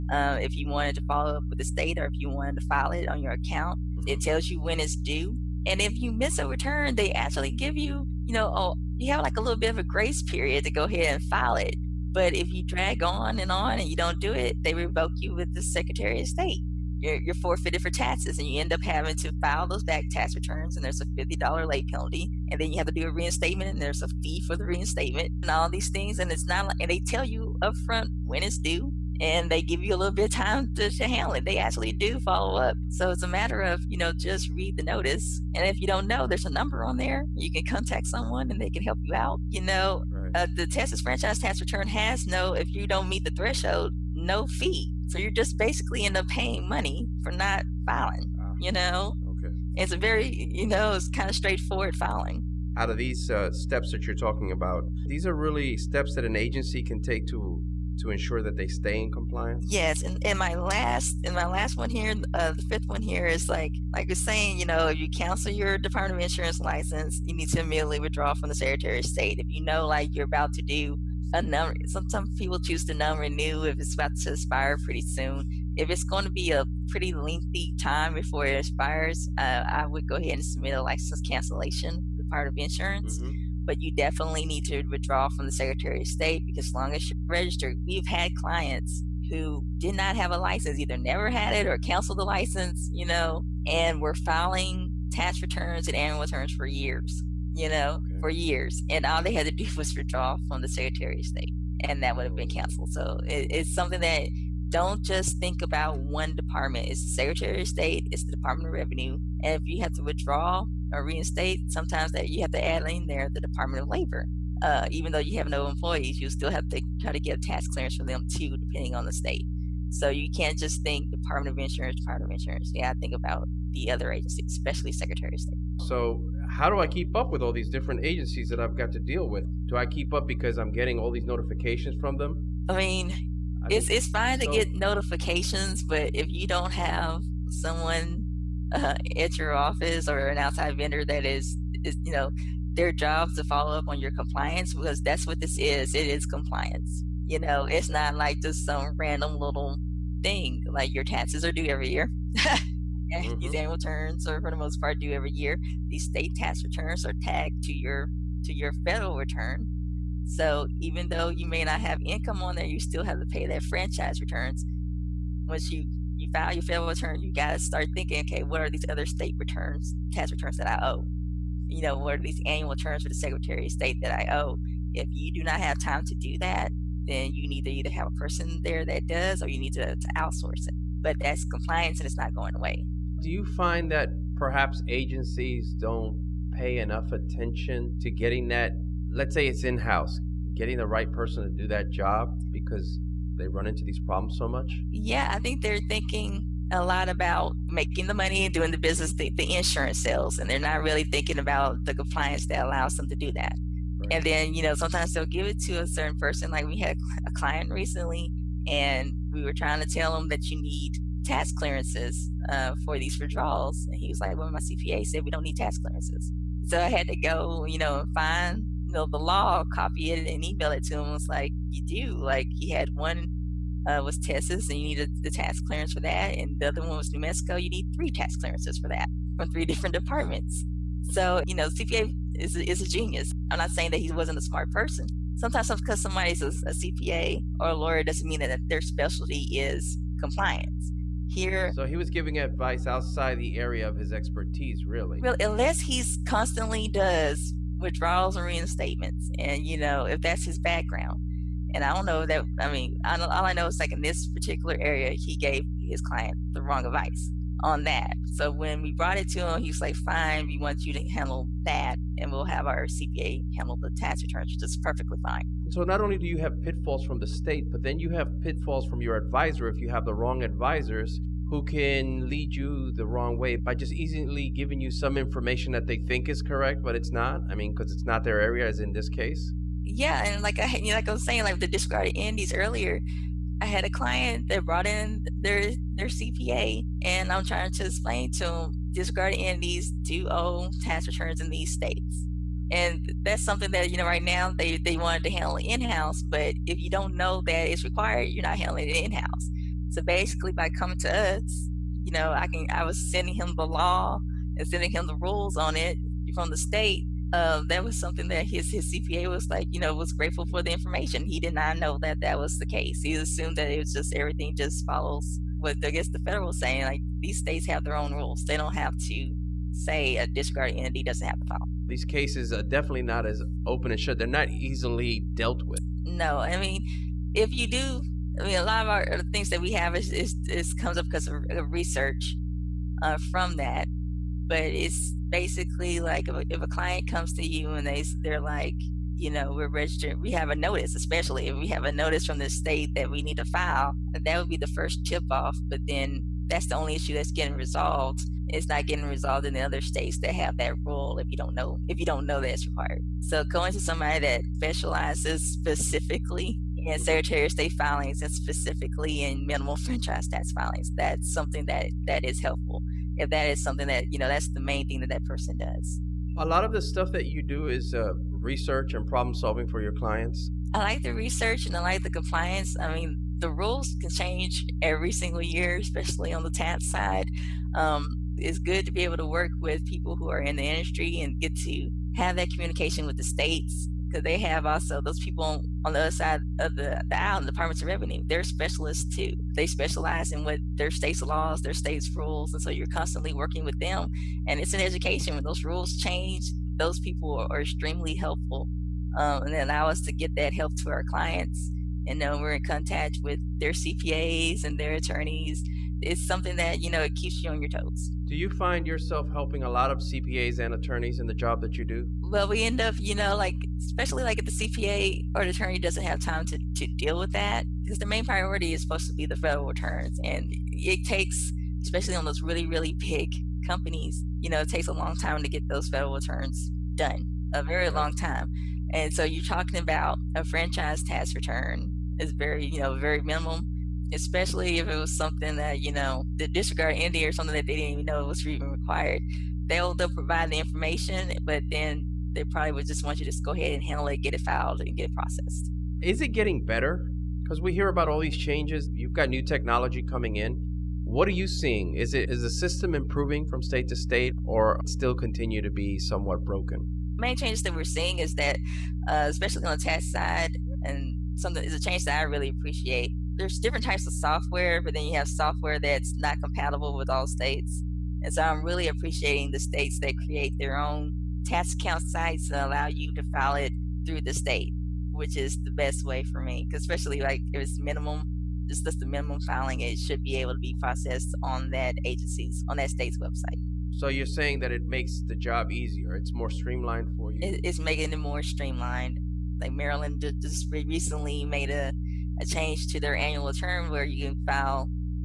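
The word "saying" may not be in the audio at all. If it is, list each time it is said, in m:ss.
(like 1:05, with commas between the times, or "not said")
1:04, 3:53, 4:41, 5:16, 8:04.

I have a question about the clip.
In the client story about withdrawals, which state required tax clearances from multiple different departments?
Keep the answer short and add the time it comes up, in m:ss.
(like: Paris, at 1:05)
New Mexico, at 3:47.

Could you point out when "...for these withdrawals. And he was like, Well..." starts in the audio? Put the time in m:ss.
3:32.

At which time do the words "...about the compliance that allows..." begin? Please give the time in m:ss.
3:21.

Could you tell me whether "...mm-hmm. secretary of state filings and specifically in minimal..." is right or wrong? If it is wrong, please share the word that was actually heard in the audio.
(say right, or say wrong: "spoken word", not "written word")
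right.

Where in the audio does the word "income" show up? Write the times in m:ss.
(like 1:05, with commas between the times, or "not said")
2:42.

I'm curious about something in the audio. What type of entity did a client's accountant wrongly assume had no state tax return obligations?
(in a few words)
Disregarded entities.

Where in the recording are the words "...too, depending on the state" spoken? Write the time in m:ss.
1:58.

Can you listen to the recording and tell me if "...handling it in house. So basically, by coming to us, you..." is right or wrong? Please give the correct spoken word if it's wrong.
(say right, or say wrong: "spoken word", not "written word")
right.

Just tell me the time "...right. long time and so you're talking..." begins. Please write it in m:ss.
7:07.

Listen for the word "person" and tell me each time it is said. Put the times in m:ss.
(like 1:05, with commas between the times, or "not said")
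2:58, 3:11, 3:26, 3:54, 6:05.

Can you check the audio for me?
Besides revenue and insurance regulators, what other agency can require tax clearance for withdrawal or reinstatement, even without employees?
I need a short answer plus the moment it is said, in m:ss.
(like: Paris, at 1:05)
Department of Labor, at 1:53.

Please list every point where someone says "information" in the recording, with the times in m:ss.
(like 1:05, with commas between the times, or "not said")
4:35, 5:10, 7:20.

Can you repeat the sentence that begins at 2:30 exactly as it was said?
Like your taxes are due every year.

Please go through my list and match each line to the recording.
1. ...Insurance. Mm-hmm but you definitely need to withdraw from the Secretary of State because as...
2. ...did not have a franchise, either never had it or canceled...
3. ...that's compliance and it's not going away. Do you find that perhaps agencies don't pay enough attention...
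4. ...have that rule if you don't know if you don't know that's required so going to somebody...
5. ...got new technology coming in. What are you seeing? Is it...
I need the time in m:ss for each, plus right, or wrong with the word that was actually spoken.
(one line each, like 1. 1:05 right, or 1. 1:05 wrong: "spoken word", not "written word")
1. 1:22 right
2. 1:29 wrong: "license", not "franchise"
3. 3:01 right
4. 5:50 right
5. 7:29 right.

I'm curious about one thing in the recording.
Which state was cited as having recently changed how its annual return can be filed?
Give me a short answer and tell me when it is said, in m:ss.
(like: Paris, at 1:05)
Maryland, at 8:09.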